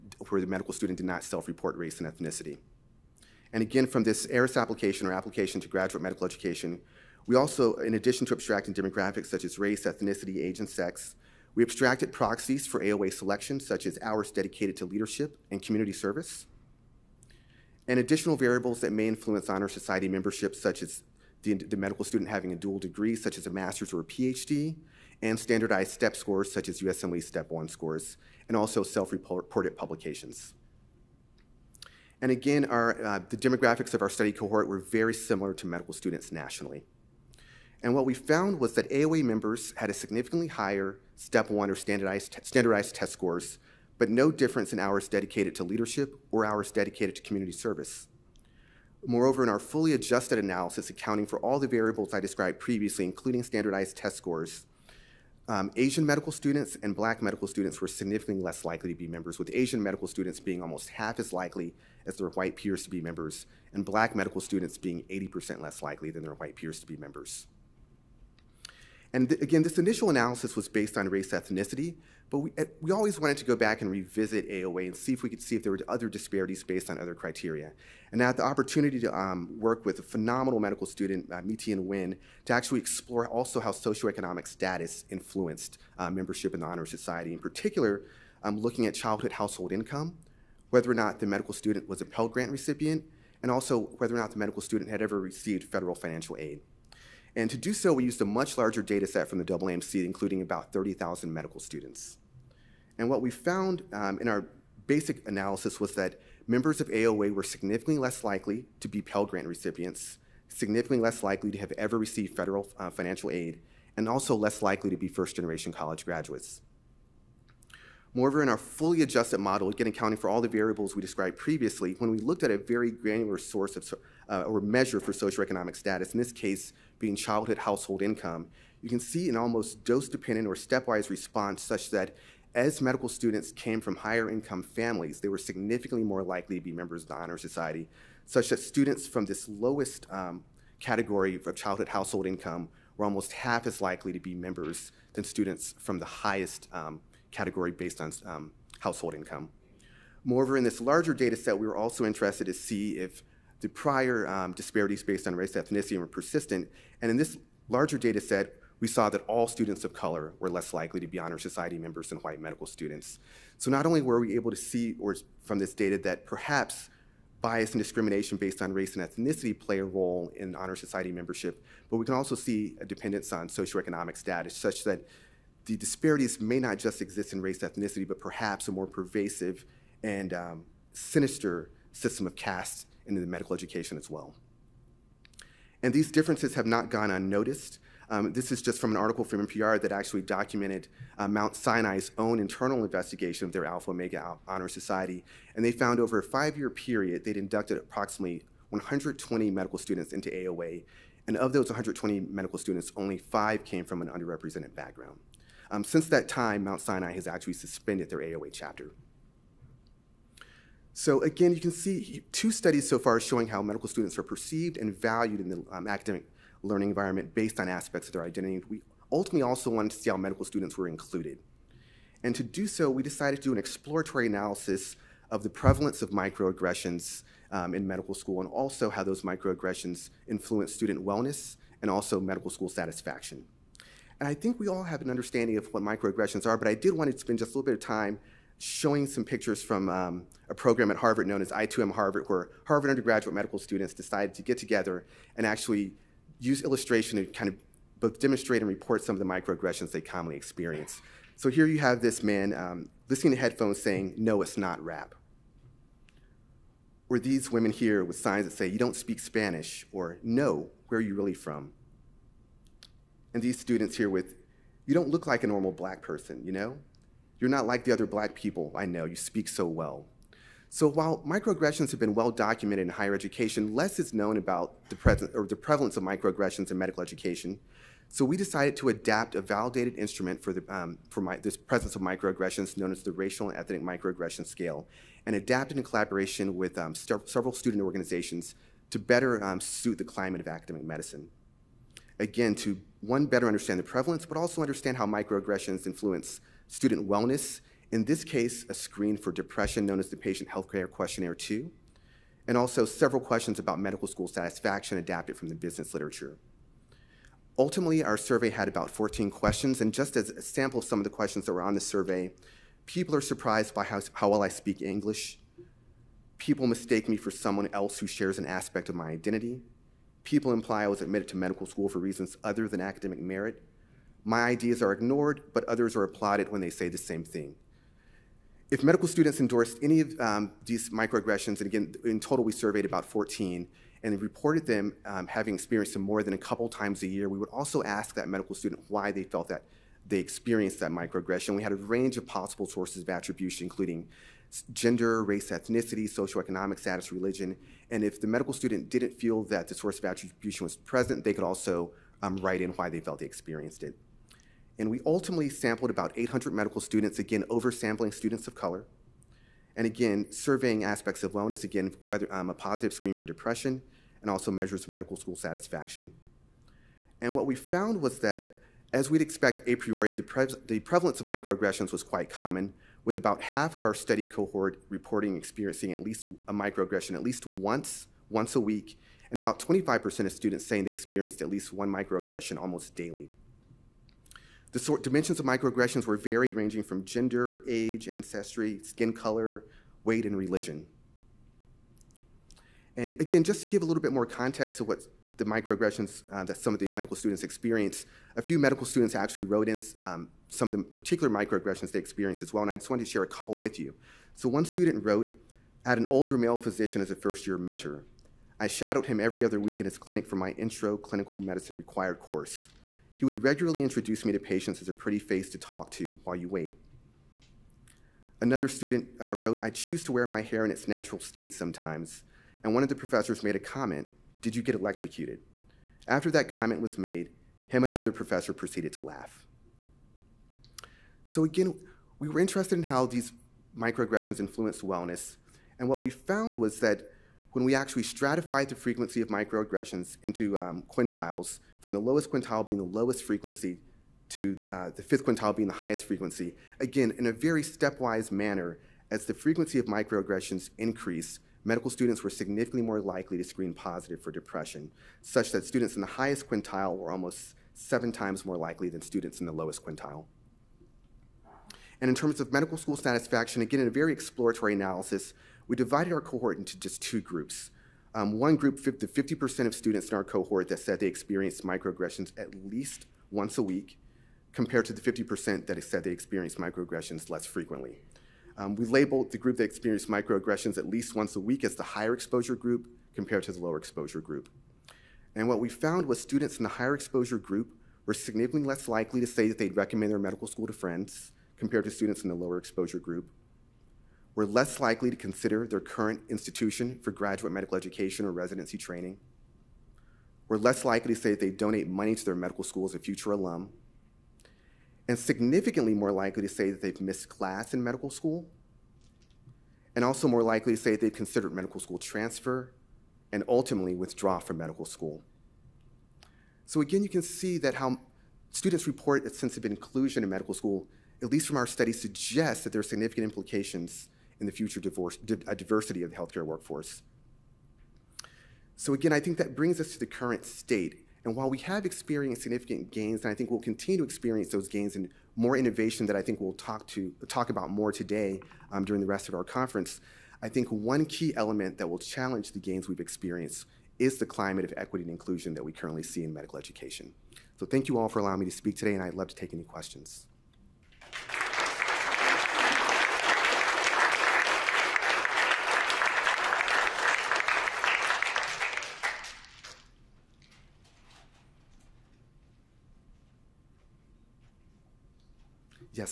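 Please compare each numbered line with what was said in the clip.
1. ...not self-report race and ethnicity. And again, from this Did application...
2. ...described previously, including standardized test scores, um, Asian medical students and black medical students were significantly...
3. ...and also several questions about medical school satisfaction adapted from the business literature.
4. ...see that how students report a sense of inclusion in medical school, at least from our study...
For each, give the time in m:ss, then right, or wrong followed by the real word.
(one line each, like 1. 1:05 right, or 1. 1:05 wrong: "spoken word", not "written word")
1. 0:01 wrong: "ERAS", not "Did"
2. 0:52 right
3. 5:02 right
4. 8:37 right.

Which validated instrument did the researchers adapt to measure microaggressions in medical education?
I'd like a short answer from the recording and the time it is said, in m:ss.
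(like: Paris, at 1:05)
Racial and Ethnic Microaggression Scale, at 4:43.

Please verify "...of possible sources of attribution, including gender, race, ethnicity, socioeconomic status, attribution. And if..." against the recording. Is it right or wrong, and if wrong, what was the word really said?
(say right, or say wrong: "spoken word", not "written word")
wrong: "religion", not "attribution".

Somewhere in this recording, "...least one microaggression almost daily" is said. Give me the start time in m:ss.
6:21.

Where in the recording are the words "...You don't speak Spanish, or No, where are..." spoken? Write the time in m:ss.
4:18.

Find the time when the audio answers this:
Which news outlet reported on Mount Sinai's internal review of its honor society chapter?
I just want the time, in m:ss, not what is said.
3:09.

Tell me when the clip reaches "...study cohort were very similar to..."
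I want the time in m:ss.
0:34.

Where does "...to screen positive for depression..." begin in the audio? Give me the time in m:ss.
7:33.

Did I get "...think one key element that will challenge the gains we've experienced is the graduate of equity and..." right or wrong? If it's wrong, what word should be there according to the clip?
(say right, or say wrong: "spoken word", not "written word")
wrong: "climate", not "graduate".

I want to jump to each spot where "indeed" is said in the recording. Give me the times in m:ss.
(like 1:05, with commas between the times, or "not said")
not said.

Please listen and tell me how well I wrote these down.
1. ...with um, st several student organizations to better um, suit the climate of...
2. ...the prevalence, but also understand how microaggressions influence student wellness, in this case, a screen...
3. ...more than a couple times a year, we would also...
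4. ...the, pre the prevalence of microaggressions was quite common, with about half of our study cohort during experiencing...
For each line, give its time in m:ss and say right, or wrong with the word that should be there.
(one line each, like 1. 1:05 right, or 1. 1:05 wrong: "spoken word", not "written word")
1. 4:46 right
2. 4:53 right
3. 5:36 right
4. 6:10 wrong: "reporting", not "during".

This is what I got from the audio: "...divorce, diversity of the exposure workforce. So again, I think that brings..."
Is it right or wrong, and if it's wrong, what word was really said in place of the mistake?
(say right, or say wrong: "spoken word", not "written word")
wrong: "healthcare", not "exposure".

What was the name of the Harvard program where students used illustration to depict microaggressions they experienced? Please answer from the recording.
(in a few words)
I2M Harvard.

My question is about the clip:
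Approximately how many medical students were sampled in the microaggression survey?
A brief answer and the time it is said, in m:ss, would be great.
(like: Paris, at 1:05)
800, at 5:56.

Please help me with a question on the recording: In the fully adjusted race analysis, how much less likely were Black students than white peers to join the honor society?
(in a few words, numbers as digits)
80%.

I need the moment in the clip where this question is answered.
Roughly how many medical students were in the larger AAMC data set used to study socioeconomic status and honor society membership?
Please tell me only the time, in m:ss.
1:40.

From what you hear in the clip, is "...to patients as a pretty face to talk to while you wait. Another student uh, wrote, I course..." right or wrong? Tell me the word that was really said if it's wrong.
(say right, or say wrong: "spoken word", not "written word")
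wrong: "choose", not "course".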